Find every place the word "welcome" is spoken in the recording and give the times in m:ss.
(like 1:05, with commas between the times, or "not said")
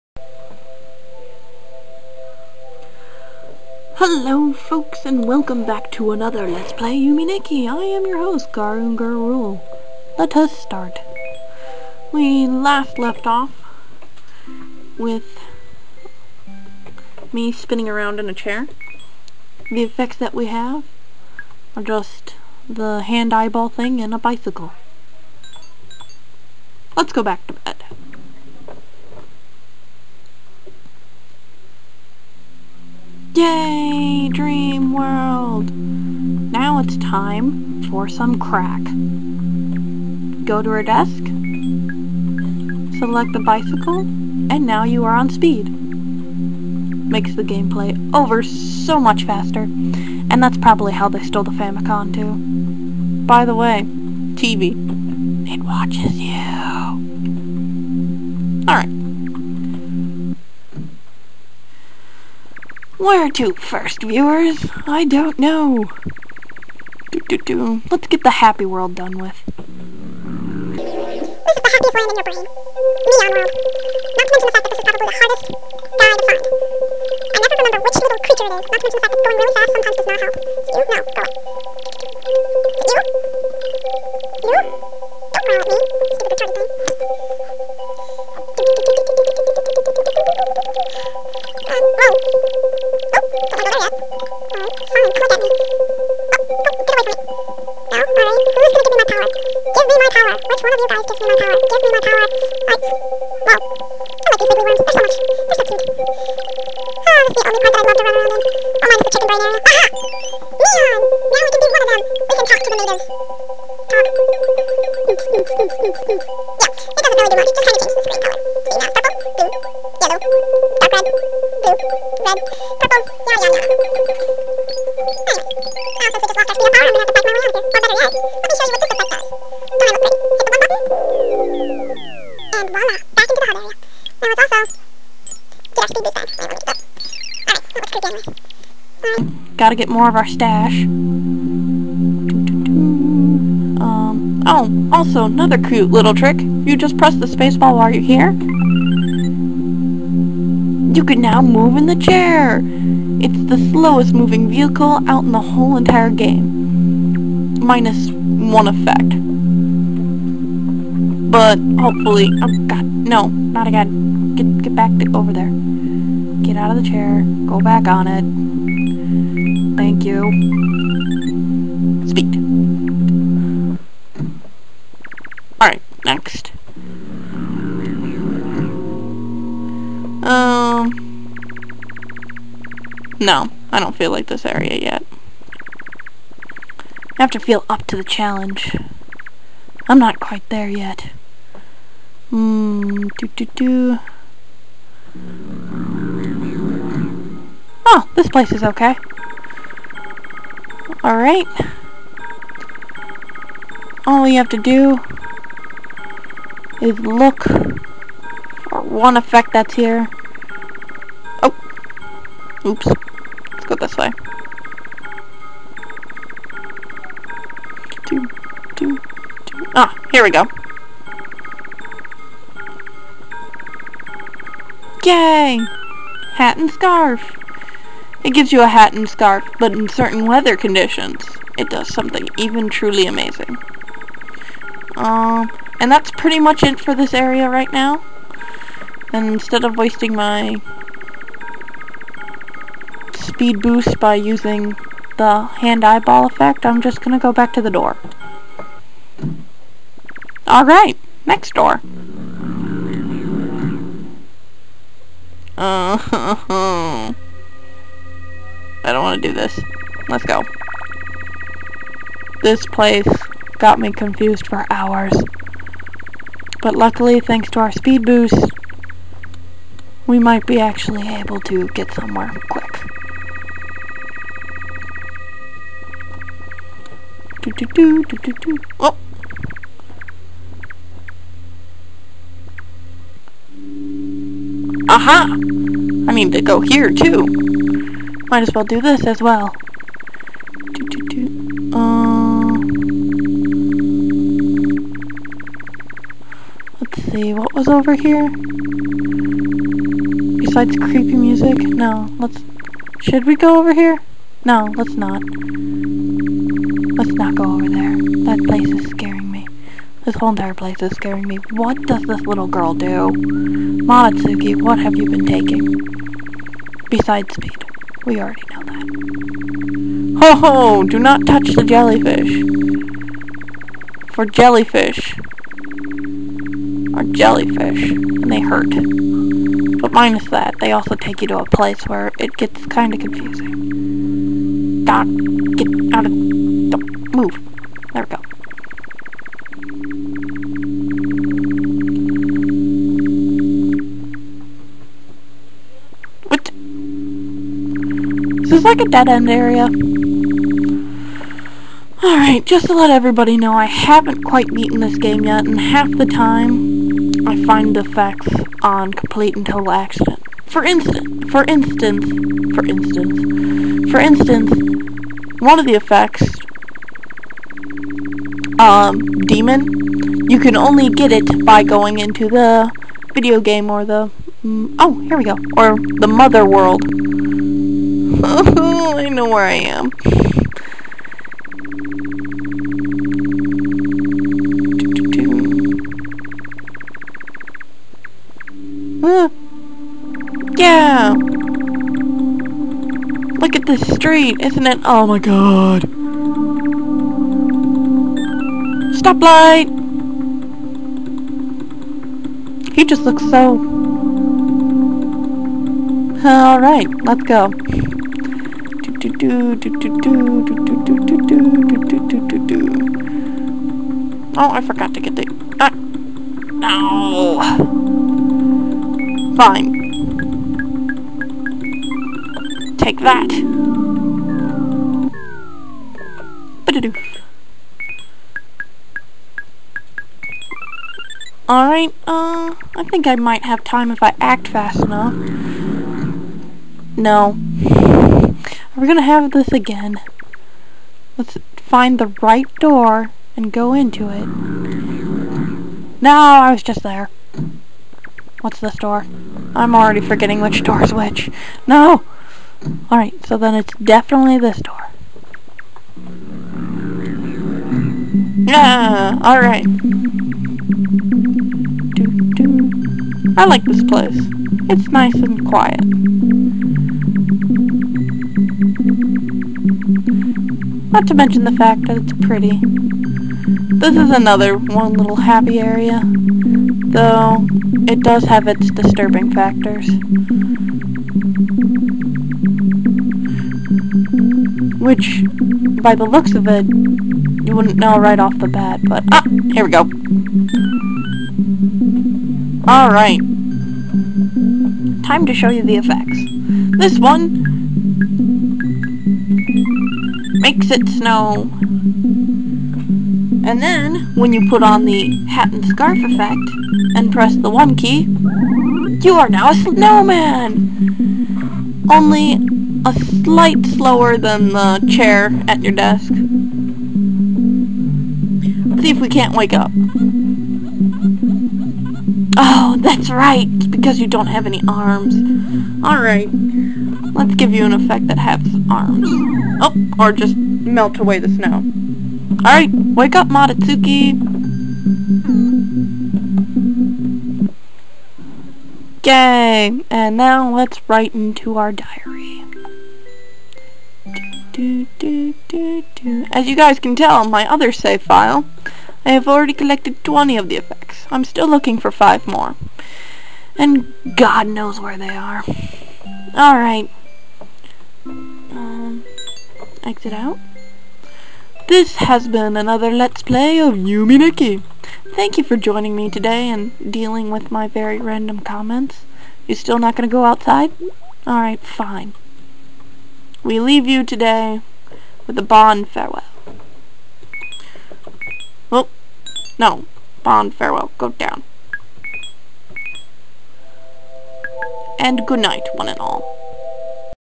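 0:05.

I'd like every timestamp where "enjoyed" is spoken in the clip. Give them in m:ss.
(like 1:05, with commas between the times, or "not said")
not said.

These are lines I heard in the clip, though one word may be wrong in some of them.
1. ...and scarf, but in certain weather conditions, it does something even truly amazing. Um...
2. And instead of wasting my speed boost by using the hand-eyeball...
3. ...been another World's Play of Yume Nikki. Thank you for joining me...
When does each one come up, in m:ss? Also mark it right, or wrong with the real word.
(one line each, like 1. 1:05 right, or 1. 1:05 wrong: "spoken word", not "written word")
1. 3:48 right
2. 3:59 right
3. 9:22 wrong: "Let", not "World".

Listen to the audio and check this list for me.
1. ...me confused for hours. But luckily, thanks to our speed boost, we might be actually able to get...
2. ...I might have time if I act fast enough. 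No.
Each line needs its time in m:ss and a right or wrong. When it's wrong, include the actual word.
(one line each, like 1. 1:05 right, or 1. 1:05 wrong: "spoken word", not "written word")
1. 4:23 right
2. 7:13 right.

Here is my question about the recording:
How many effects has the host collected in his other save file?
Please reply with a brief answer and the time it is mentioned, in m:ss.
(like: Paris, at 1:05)
20, at 9:10.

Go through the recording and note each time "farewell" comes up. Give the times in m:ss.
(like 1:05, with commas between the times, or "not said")
9:35, 9:40.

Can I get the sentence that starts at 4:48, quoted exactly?
Might as well do this as well.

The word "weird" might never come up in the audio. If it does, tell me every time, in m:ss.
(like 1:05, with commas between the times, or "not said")
not said.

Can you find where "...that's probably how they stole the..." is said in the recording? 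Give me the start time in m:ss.
0:50.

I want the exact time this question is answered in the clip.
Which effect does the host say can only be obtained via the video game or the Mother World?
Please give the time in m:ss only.
6:09.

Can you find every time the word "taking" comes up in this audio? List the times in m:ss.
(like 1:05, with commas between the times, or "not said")
5:15.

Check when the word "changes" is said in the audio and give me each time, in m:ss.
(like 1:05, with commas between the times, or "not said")
1:57.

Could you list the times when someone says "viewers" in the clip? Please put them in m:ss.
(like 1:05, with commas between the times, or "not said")
1:04.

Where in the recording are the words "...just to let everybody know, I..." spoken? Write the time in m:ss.
5:52.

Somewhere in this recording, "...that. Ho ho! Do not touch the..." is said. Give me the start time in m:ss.
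5:18.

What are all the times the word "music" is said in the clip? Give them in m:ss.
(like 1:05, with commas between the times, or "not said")
5:01.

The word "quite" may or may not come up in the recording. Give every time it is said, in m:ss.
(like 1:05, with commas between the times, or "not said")
3:10, 5:54.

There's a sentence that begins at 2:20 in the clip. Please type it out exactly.
Um, oh, also another cute little trick.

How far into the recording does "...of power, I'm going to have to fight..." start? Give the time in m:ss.
2:06.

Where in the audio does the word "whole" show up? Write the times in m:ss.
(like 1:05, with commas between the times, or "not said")
2:35, 5:10.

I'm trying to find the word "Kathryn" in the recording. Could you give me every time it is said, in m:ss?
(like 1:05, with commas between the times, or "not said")
not said.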